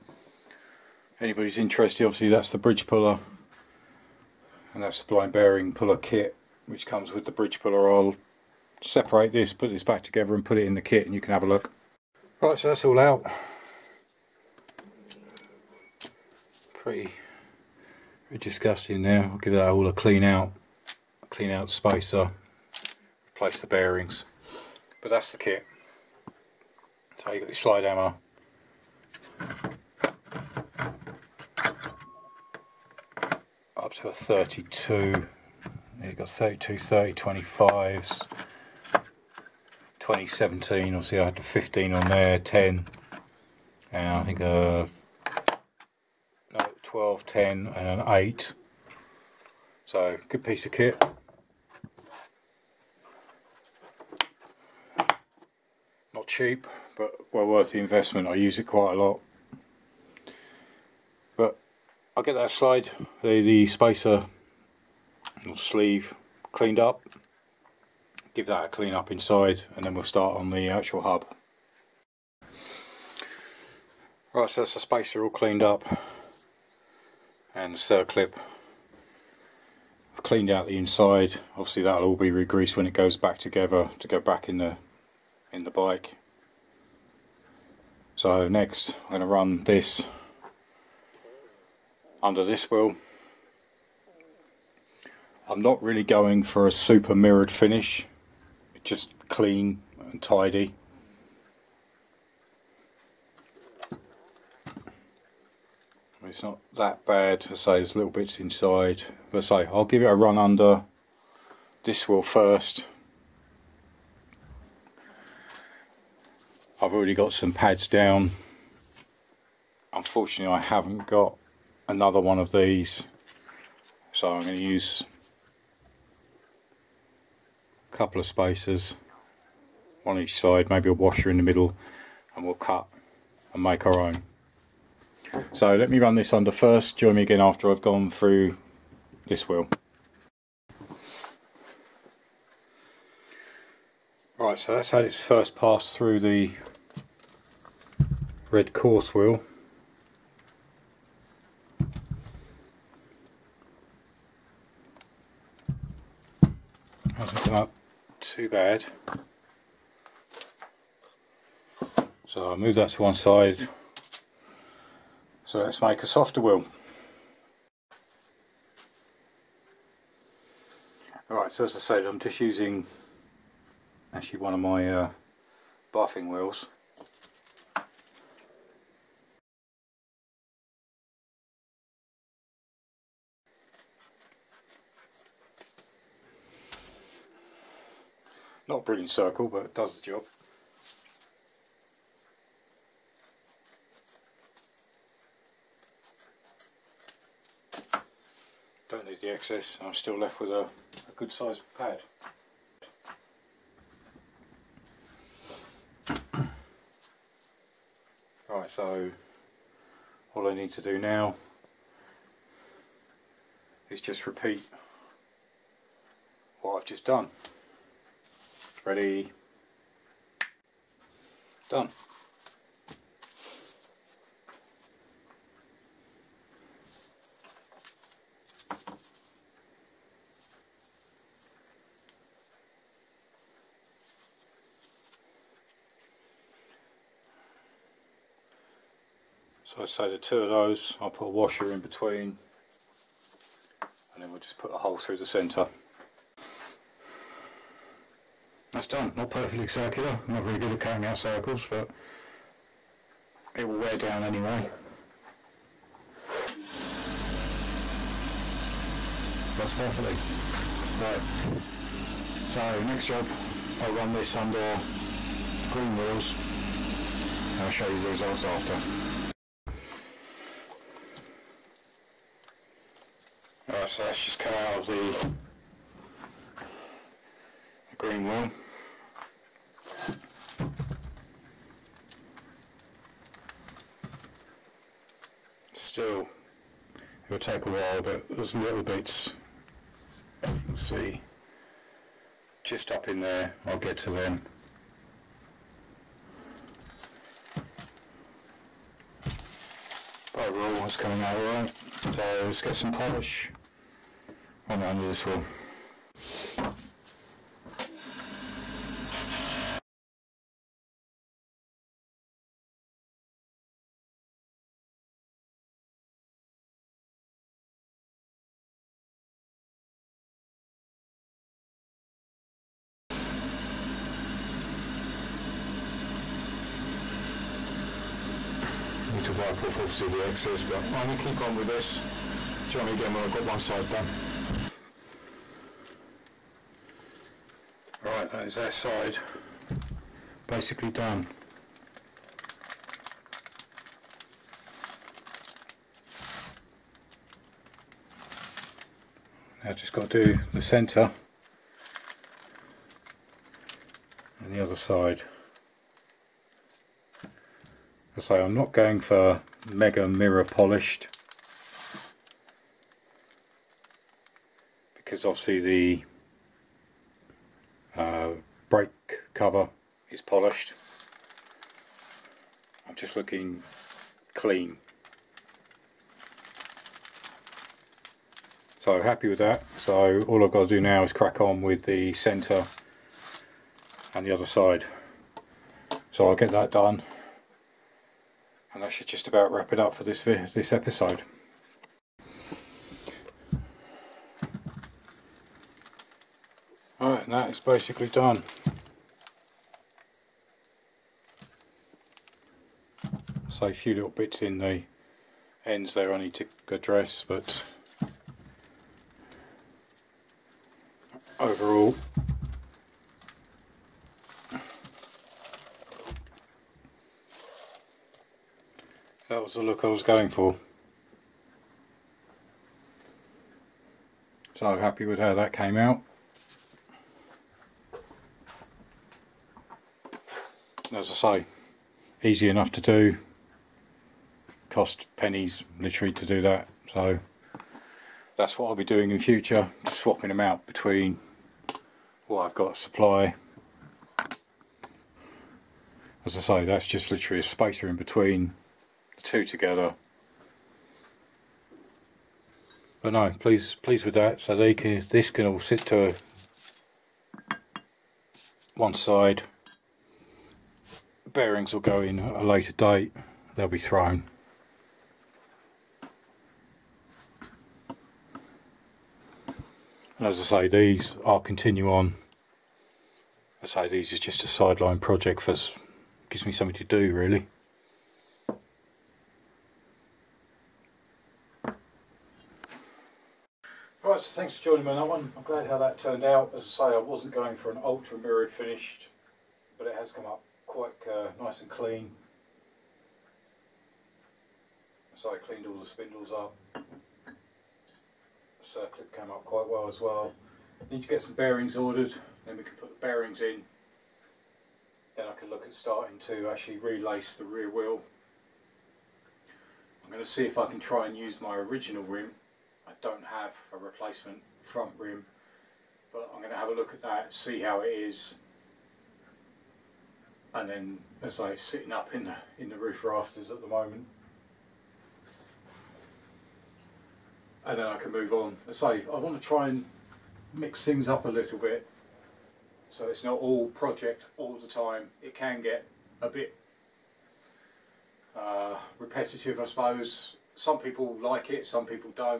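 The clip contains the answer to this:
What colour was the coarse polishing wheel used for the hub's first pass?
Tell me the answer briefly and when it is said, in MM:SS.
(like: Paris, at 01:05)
Red, at 02:28.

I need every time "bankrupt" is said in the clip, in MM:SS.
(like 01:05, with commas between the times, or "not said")
not said.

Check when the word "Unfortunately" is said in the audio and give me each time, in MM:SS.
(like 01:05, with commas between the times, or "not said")
01:59.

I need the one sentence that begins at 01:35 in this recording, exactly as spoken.
I'm not really going for a super mirrored finish, just clean and tidy.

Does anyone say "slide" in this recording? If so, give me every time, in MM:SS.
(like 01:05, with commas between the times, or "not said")
00:27, 01:02.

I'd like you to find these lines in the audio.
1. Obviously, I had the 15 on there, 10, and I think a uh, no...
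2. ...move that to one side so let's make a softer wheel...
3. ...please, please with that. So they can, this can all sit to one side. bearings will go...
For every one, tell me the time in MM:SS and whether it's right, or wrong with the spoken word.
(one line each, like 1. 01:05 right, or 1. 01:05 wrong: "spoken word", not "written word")
1. 00:40 right
2. 02:42 right
3. 07:33 right.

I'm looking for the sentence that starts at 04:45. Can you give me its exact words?
Still, it'll take a while, but there's little bits.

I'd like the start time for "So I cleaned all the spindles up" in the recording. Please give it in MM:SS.
08:15.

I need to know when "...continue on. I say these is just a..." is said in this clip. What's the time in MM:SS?
07:51.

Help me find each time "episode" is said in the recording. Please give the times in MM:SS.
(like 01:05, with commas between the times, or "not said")
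06:30.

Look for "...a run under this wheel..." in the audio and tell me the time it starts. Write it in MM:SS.
01:50.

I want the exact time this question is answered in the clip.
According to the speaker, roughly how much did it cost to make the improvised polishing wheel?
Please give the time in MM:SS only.
07:15.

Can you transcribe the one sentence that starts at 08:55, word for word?
It can get a bit uh, repetitive, I suppose.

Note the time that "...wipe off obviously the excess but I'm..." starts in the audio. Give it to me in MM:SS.
05:29.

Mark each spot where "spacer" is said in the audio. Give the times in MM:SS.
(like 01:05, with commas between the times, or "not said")
00:21, 01:03, 01:14, 02:08, 07:27.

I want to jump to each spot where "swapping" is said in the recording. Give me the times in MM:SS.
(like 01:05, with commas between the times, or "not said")
07:19.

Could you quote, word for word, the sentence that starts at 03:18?
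Don't need the excess, I'm still left with a, a good sized pad.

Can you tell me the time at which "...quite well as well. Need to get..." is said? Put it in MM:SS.
08:19.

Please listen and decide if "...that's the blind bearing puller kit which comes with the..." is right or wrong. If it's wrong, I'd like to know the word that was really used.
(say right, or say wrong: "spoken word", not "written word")
right.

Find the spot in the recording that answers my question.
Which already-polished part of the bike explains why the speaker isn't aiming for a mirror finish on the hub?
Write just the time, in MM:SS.
06:08.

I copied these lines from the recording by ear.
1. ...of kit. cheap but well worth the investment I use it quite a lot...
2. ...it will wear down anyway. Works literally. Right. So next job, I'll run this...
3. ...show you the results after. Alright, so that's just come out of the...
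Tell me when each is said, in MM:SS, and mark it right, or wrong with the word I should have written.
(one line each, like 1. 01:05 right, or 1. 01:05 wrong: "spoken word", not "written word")
1. 00:50 right
2. 04:13 wrong: "perfectly", not "literally"
3. 04:27 right.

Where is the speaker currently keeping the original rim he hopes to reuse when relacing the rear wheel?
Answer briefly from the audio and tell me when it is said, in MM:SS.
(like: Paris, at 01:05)
Roof rafters, at 08:42.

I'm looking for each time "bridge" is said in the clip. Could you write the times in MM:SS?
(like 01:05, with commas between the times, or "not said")
00:02, 00:07.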